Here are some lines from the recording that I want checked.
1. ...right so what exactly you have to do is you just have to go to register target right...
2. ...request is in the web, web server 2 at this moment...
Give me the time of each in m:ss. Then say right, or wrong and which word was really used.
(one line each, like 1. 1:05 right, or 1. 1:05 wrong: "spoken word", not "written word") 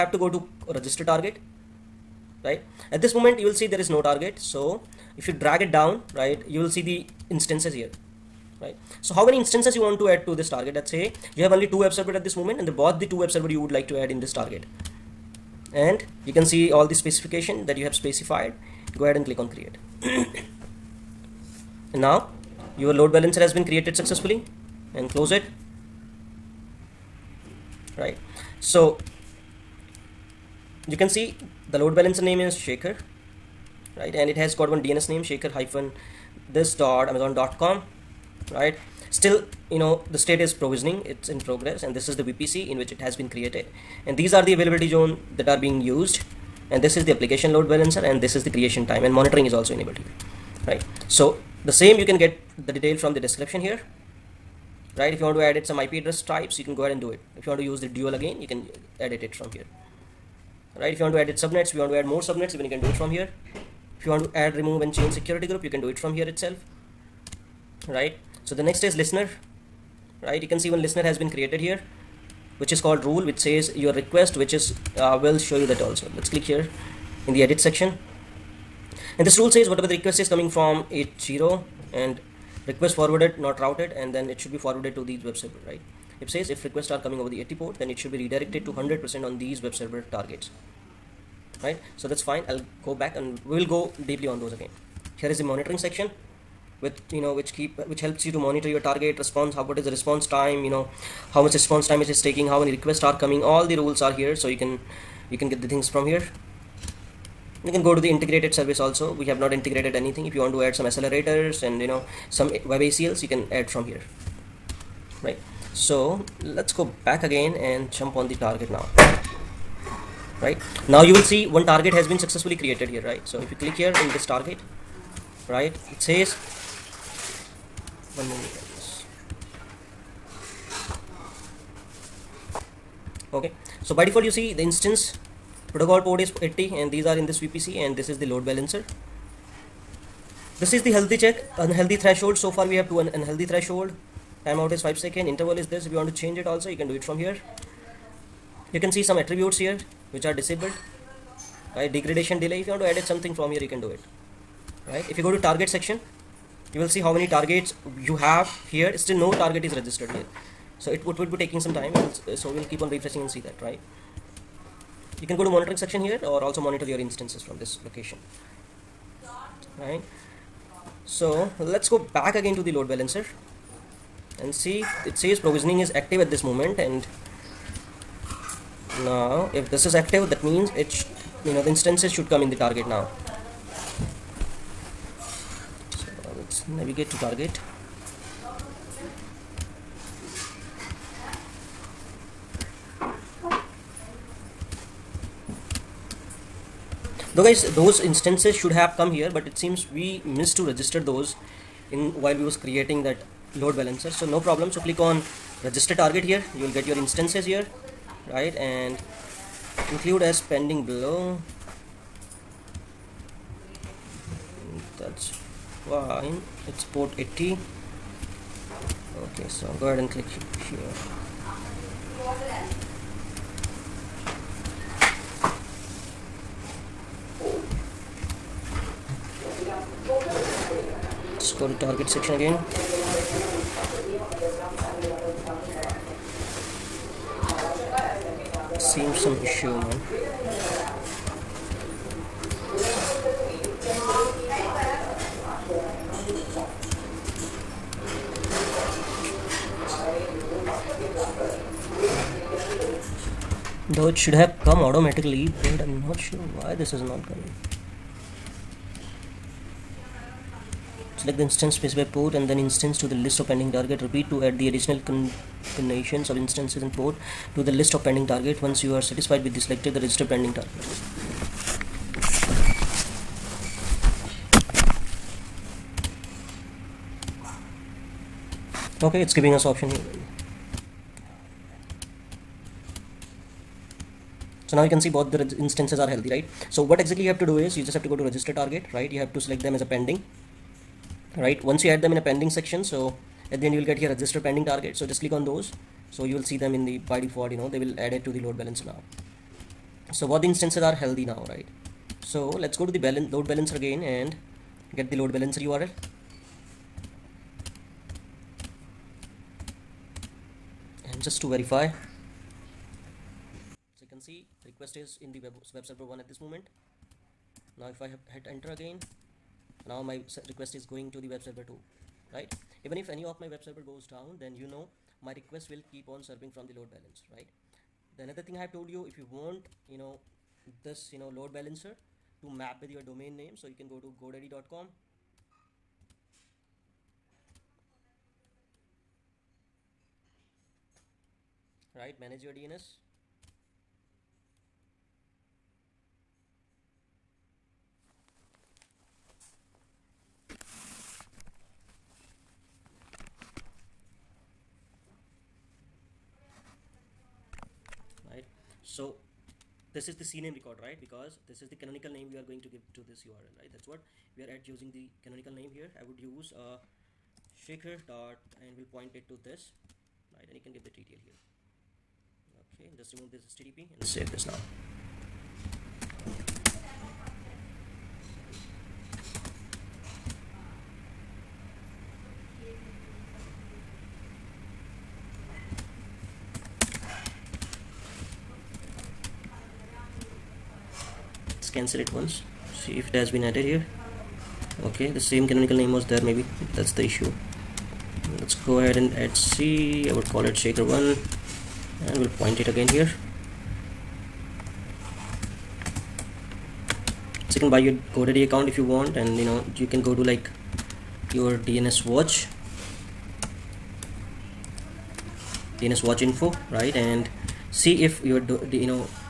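1. 4:46 right
2. 5:14 wrong: "1", not "2".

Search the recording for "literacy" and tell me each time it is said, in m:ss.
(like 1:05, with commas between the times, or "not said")
not said.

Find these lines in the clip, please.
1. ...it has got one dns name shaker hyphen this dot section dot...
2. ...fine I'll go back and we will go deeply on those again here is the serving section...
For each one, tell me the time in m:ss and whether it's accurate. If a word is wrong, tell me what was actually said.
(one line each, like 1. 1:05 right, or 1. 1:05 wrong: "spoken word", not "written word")
1. 0:34 wrong: "amazon", not "section"
2. 1:32 wrong: "monitoring", not "serving".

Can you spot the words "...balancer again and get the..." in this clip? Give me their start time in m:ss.
5:03.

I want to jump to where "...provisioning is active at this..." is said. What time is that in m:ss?
2:55.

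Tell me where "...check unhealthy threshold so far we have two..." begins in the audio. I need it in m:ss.
2:21.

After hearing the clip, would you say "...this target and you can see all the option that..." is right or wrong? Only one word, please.
wrong.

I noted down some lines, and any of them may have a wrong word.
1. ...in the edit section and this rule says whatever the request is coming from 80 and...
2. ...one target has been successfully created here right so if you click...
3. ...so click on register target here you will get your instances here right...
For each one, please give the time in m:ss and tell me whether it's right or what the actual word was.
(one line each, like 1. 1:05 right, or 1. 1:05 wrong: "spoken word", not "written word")
1. 1:17 right
2. 2:01 right
3. 3:24 right.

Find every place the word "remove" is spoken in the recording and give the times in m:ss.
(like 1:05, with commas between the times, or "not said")
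1:04, 6:13.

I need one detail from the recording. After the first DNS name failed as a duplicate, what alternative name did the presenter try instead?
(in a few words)
shaker1.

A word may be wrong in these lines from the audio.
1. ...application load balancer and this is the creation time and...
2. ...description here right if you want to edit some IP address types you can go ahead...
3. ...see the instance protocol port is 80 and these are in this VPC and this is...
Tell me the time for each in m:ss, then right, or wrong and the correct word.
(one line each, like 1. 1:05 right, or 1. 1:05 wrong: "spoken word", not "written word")
1. 0:47 right
2. 0:53 right
3. 2:14 right.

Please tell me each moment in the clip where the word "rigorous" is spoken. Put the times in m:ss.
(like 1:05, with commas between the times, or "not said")
not said.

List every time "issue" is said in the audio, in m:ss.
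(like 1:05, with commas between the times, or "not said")
3:59, 6:37.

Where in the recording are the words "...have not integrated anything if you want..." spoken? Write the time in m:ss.
1:49.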